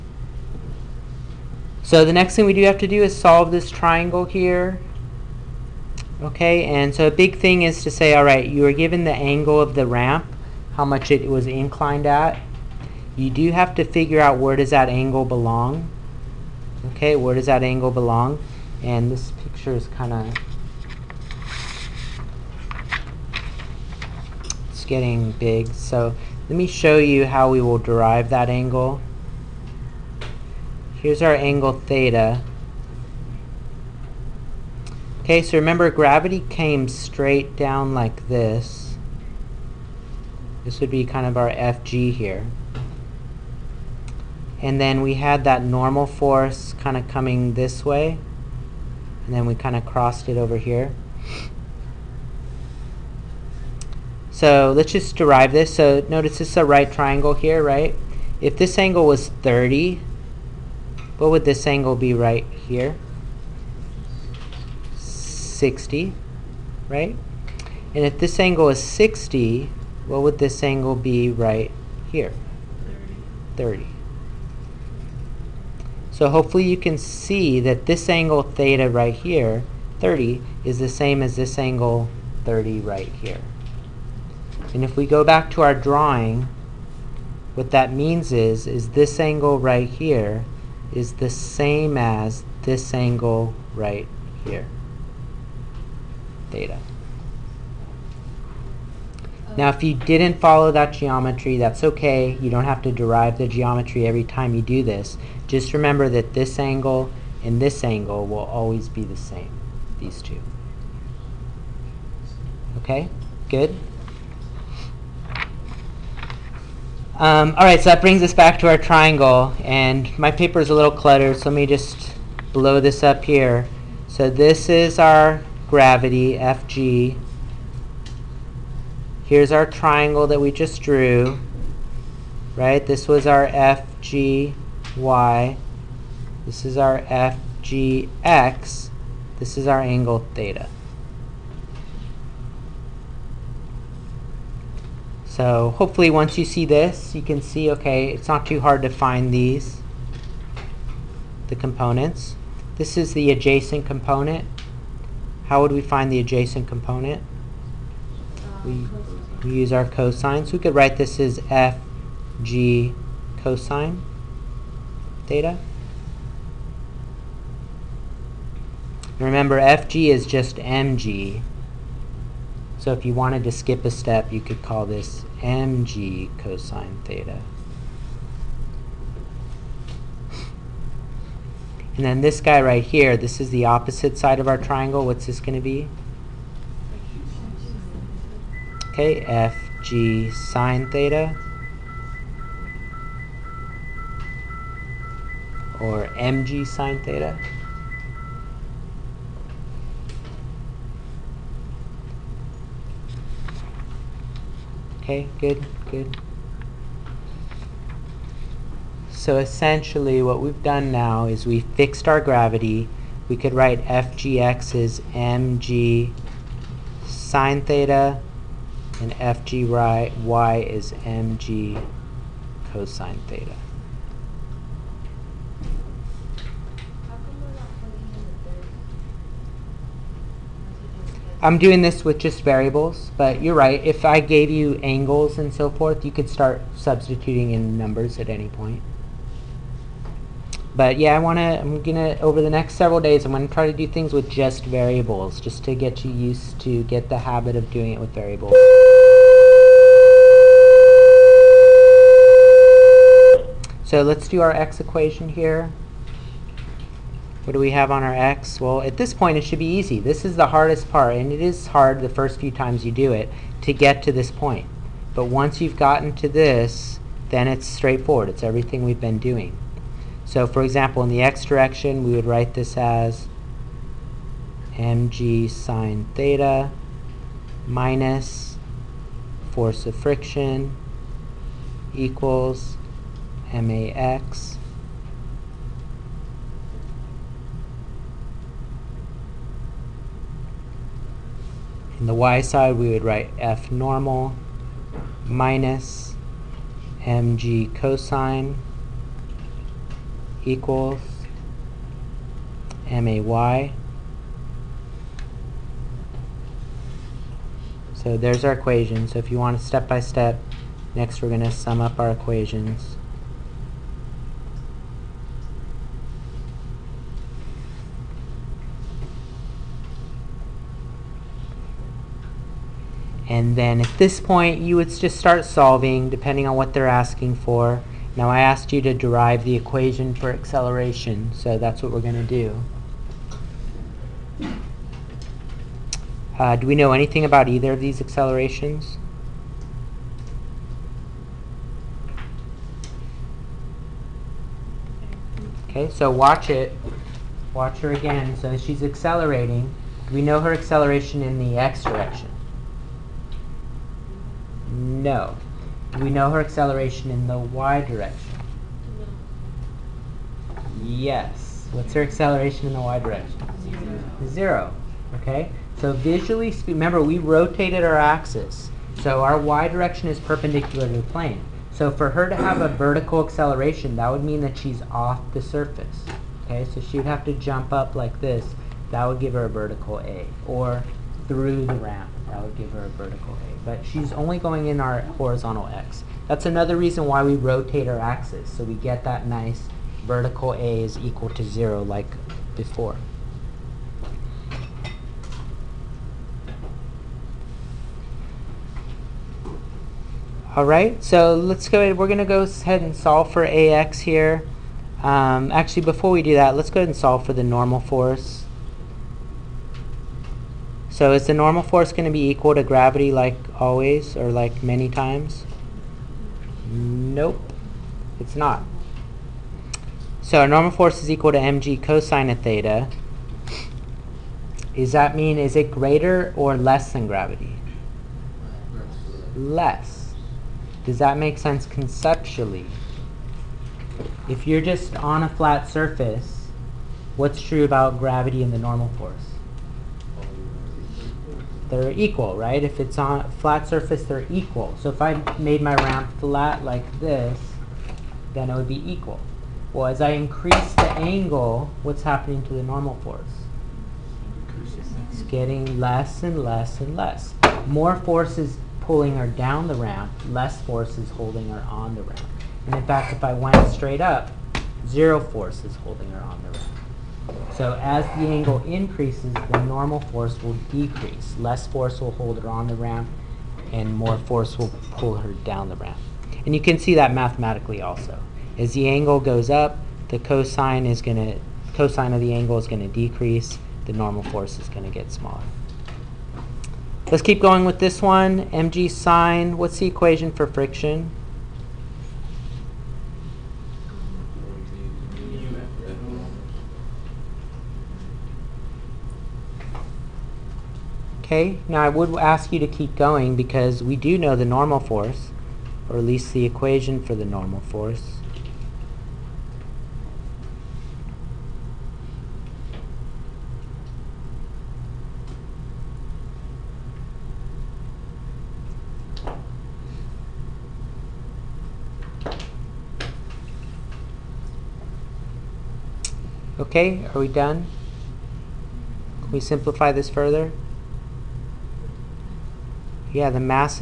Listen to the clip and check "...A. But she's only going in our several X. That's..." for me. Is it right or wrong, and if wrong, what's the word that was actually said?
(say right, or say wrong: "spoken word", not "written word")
wrong: "horizontal", not "several".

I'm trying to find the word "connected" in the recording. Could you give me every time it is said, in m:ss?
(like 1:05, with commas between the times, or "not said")
not said.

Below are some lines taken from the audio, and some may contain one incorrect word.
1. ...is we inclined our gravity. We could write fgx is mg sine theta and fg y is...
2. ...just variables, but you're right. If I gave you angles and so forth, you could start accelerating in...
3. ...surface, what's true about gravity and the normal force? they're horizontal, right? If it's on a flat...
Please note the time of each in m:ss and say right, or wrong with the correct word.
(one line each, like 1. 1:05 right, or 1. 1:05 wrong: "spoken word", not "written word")
1. 3:31 wrong: "fixed", not "inclined"
2. 3:52 wrong: "substituting", not "accelerating"
3. 7:15 wrong: "equal", not "horizontal".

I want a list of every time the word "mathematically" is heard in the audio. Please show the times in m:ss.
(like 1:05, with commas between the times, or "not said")
7:57.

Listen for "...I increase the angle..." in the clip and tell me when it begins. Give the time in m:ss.
7:30.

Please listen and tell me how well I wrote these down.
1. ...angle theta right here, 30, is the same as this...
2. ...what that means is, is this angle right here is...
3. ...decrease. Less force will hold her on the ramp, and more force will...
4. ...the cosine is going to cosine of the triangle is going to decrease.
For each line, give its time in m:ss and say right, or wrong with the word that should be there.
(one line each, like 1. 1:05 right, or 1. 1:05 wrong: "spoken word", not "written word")
1. 1:18 right
2. 1:27 right
3. 7:50 right
4. 8:00 wrong: "angle", not "triangle".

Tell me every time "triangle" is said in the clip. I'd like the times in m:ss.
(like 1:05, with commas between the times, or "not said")
0:03, 0:56, 1:58, 2:09, 3:04.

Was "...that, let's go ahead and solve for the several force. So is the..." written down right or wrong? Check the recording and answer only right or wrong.
wrong.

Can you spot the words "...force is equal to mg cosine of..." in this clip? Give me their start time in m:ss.
7:00.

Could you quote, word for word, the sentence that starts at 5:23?
And then at this point, you would just start solving depending on what they're asking for.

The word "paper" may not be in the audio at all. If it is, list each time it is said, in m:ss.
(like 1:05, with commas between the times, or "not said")
2:00.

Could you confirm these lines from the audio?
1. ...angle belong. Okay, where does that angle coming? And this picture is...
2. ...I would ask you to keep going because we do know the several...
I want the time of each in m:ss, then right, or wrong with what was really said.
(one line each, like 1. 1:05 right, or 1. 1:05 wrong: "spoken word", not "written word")
1. 0:14 wrong: "belong", not "coming"
2. 8:21 wrong: "normal", not "several".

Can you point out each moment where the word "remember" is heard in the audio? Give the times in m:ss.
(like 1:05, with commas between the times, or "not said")
0:35, 1:45, 2:49, 6:06.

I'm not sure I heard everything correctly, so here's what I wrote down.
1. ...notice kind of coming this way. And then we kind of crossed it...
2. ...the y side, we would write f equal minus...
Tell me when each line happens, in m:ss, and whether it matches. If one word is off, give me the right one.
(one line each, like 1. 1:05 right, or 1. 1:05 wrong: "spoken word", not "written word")
1. 0:46 wrong: "force", not "notice"
2. 4:52 wrong: "normal", not "equal".